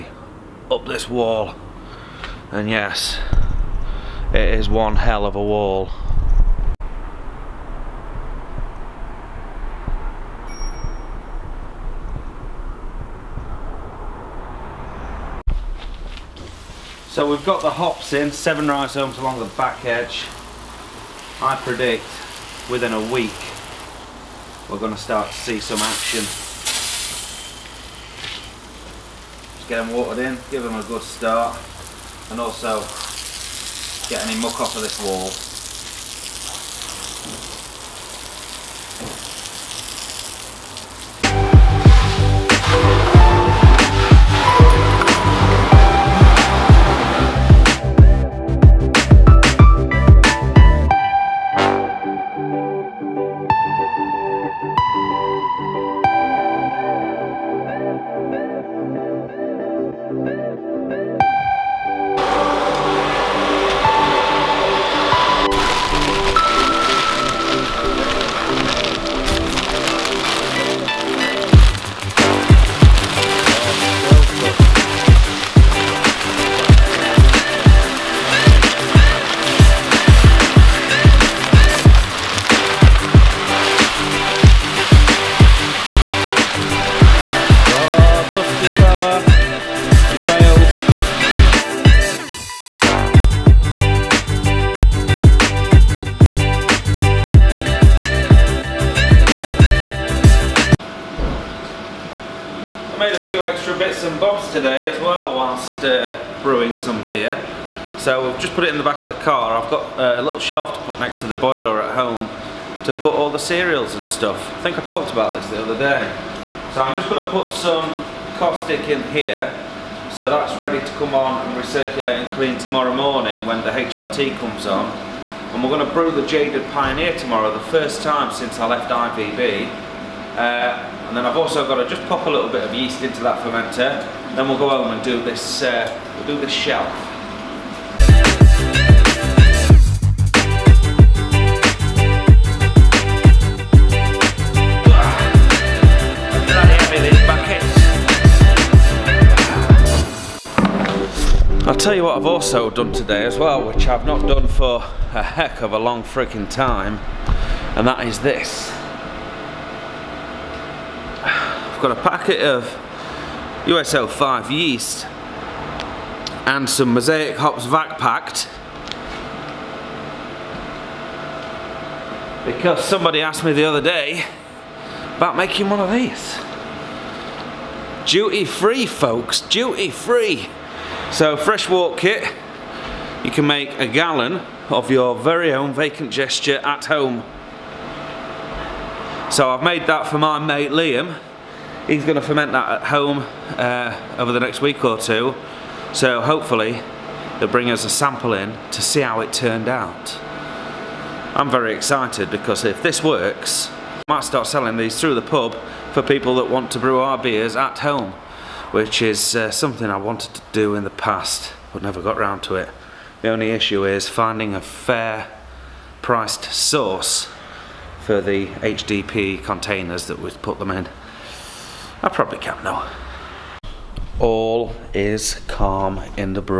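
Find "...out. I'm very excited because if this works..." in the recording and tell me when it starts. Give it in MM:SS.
03:19.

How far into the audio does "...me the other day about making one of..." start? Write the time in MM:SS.
02:53.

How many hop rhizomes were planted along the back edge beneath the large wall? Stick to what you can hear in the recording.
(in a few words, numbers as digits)
7.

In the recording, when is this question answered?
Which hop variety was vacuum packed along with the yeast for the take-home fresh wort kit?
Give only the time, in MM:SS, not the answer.
02:46.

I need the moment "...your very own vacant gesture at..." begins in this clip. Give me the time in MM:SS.
03:04.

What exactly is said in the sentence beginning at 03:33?
The only issue is finding a fair priced source for the HDP containers that we've put them in.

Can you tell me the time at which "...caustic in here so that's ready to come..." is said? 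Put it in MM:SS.
01:58.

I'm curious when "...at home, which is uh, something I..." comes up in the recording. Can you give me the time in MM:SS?
03:27.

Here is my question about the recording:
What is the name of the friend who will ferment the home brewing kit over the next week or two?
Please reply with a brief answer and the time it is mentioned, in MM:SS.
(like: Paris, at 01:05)
Liam, at 03:10.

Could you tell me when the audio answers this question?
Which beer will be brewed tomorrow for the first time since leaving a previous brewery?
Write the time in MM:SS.
02:06.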